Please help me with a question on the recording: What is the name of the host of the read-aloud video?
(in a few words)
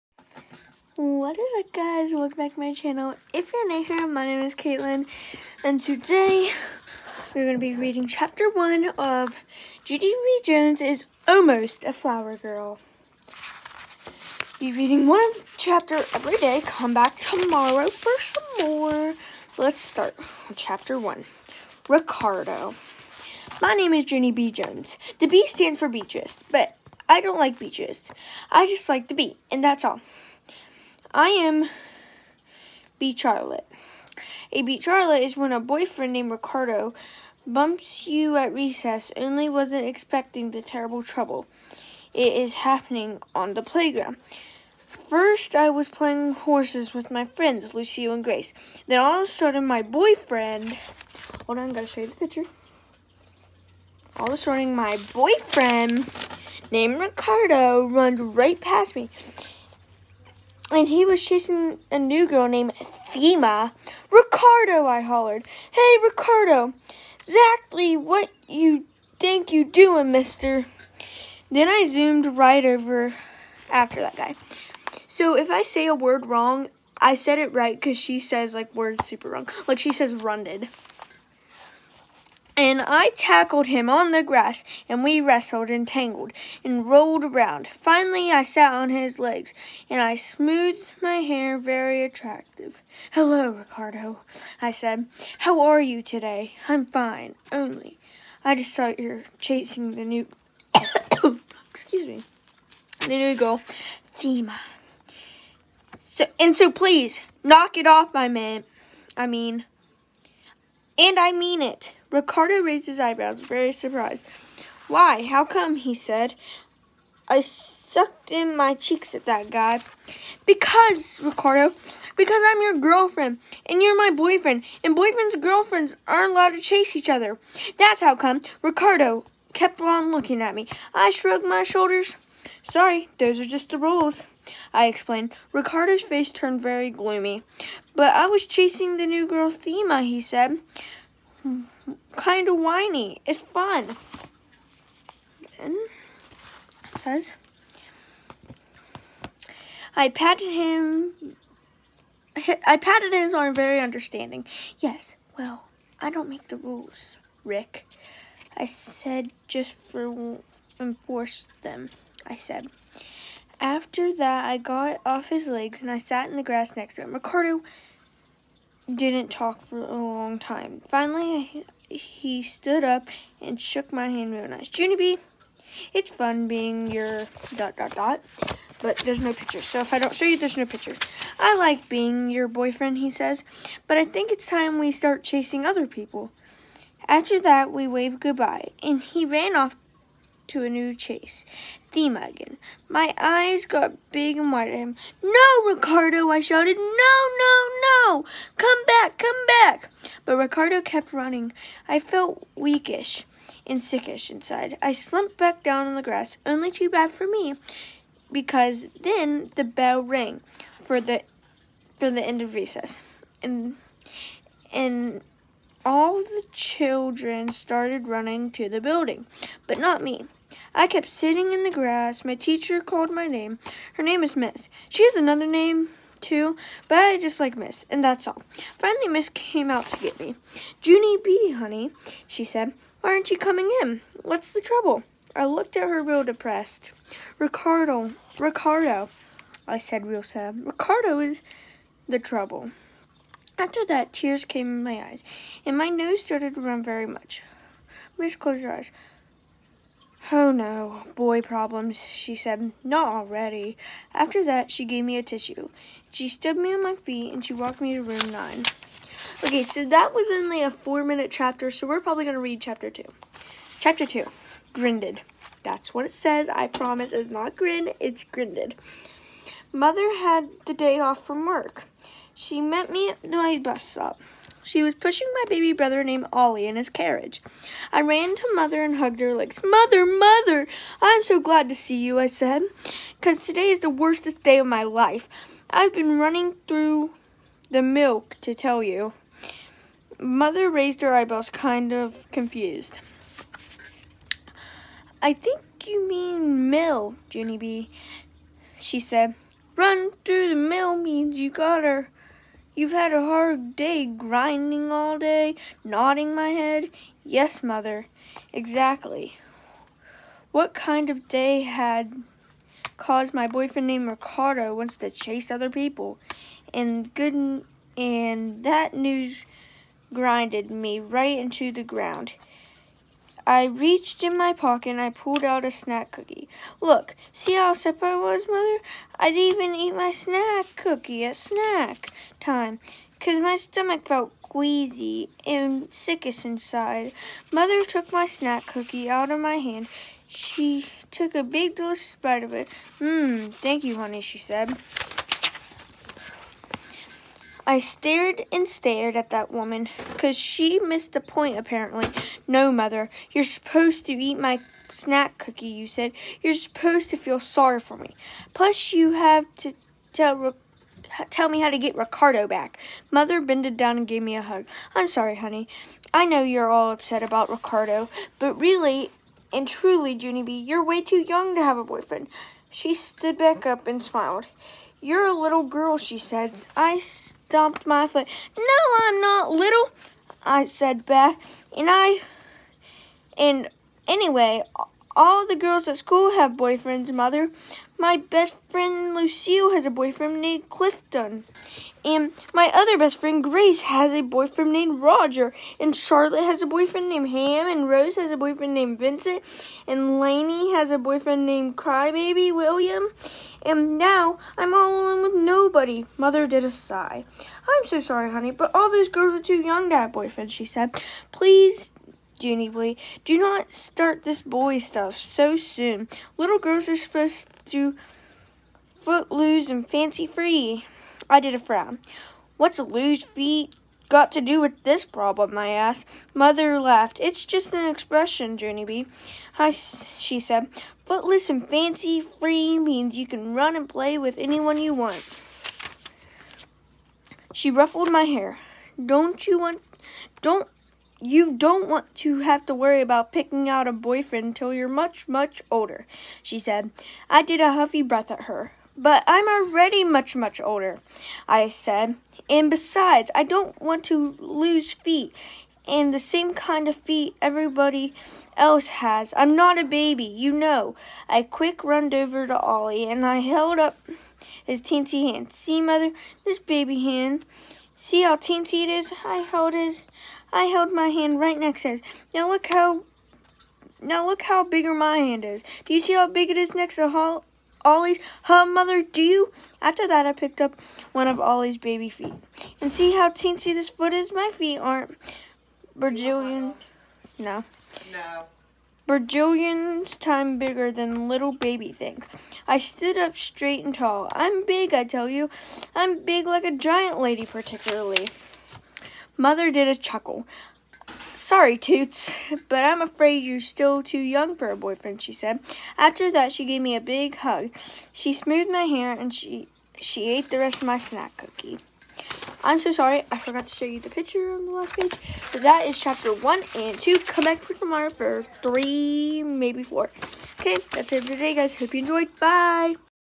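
Caitlin.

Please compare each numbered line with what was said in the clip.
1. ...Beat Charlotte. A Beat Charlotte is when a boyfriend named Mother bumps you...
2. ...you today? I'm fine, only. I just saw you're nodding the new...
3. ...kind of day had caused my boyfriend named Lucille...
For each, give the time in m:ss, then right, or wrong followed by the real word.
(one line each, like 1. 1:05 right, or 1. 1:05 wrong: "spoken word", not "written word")
1. 0:32 wrong: "Ricardo", not "Mother"
2. 1:35 wrong: "chasing", not "nodding"
3. 5:10 wrong: "Ricardo", not "Lucille".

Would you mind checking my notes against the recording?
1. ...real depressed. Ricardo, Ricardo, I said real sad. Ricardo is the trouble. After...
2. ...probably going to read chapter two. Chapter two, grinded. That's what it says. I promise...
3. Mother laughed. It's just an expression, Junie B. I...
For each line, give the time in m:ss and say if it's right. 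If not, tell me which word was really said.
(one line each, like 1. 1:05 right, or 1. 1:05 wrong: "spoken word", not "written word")
1. 3:56 right
2. 4:22 right
3. 7:06 right.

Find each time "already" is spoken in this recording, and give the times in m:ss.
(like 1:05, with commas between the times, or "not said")
4:13, 7:29.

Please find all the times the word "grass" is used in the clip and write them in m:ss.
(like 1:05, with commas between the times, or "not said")
1:24, 2:46, 3:26, 3:41.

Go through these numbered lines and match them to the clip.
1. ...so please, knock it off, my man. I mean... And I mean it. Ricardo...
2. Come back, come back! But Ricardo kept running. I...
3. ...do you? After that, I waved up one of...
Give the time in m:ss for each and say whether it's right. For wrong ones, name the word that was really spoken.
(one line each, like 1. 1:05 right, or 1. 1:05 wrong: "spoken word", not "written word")
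1. 1:46 right
2. 3:18 right
3. 7:59 wrong: "picked", not "waved".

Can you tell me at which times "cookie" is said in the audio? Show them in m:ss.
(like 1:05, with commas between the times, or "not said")
5:26, 5:30, 5:38, 5:55, 8:31.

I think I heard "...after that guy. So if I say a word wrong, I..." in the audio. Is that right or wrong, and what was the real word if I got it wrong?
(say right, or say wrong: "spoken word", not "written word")
right.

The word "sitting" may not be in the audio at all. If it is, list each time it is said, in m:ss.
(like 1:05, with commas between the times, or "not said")
3:41.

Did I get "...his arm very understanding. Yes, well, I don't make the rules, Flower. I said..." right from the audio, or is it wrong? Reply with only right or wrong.
wrong.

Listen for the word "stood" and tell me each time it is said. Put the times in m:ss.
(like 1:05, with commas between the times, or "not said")
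2:52, 4:16, 6:12, 8:12.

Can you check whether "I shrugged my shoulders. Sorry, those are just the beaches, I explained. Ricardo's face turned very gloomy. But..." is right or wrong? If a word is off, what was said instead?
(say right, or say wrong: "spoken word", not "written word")
wrong: "rules", not "beaches".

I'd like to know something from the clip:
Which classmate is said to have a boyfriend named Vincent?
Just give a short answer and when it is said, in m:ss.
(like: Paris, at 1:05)
Rose, at 6:37.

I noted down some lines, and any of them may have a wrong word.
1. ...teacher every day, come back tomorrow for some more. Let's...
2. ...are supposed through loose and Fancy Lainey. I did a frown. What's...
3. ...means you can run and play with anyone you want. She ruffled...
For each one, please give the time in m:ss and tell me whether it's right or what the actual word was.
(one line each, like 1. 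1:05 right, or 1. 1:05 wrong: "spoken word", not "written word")
1. 0:15 wrong: "chapter", not "teacher"
2. 6:56 wrong: "Free", not "Lainey"
3. 7:12 right.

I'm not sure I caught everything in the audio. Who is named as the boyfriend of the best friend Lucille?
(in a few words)
Clifton.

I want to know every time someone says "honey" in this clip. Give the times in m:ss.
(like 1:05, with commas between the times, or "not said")
3:51, 5:43, 6:05, 6:48.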